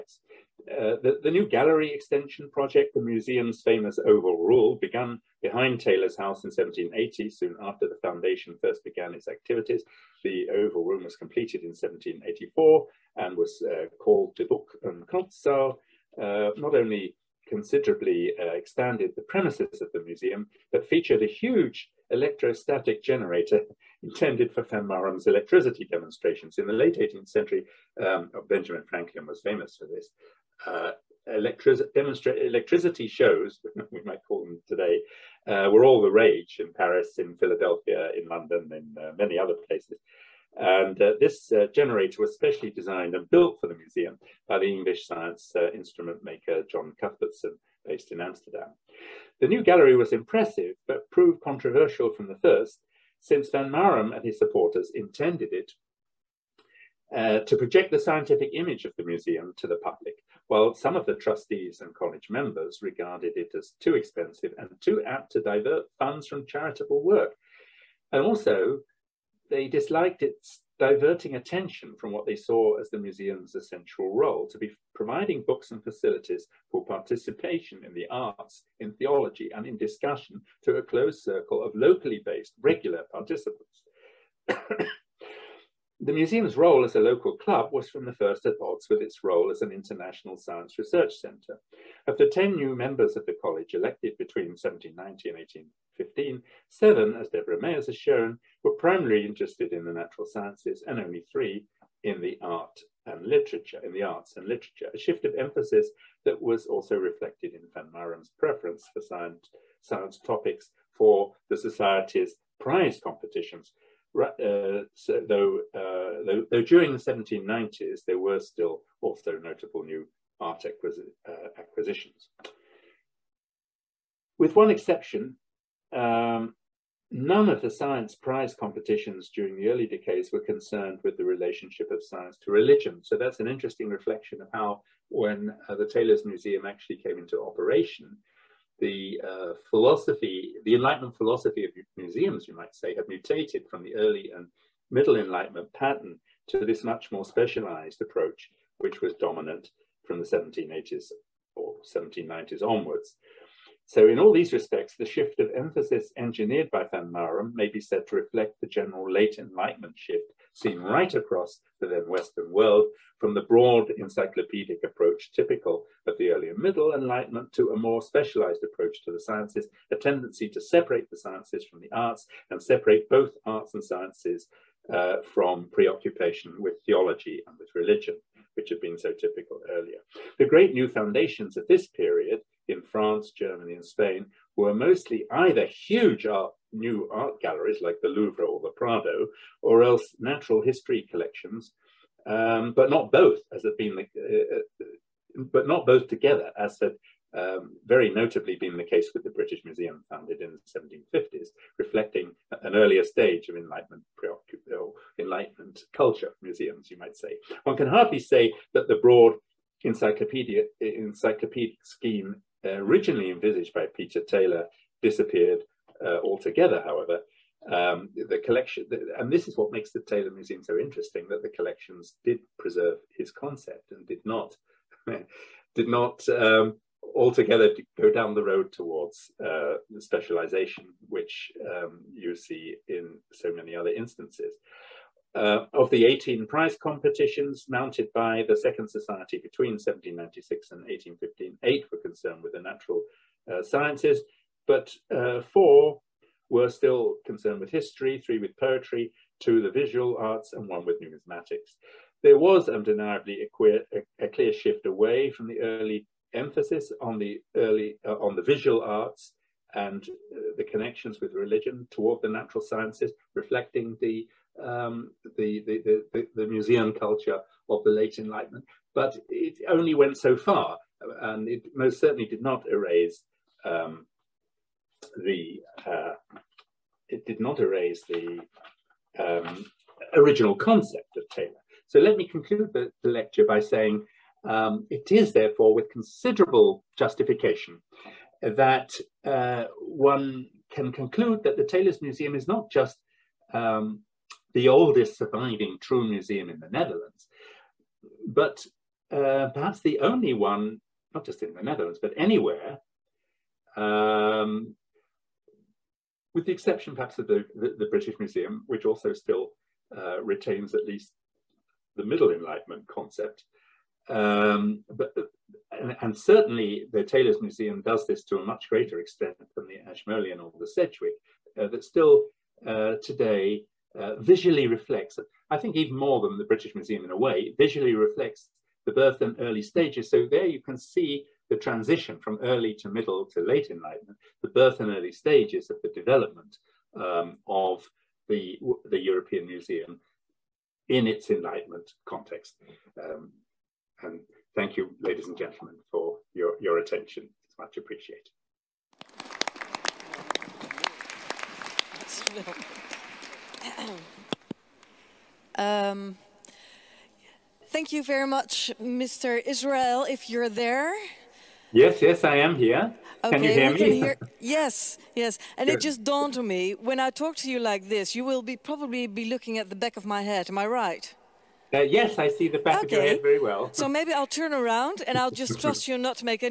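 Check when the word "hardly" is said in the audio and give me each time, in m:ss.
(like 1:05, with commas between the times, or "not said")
3:27.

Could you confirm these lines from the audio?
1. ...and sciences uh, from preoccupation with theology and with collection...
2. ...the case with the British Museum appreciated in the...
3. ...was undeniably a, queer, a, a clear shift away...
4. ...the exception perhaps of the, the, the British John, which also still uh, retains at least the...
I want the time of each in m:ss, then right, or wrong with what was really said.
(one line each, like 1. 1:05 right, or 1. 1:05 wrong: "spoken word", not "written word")
1. 2:53 wrong: "religion", not "collection"
2. 3:18 wrong: "founded", not "appreciated"
3. 4:12 right
4. 5:06 wrong: "Museum", not "John".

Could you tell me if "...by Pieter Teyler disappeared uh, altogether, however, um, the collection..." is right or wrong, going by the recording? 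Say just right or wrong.
right.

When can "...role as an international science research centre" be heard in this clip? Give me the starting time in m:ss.
1:29.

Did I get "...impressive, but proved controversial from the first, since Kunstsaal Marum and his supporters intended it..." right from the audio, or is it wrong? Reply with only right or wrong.
wrong.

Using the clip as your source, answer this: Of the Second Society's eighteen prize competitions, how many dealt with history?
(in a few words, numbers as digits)
4.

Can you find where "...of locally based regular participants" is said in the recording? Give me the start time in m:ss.
1:21.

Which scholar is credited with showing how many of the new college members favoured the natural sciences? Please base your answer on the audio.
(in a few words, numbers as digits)
Debora Meijers.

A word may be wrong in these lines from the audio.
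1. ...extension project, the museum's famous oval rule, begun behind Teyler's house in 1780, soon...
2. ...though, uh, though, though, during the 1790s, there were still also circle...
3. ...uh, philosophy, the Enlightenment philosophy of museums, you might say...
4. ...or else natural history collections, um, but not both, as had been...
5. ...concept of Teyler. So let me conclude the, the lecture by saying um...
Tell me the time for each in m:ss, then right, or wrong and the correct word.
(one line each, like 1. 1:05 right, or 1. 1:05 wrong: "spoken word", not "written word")
1. 0:01 right
2. 1:55 wrong: "notable", not "circle"
3. 2:19 right
4. 3:09 right
5. 4:40 right.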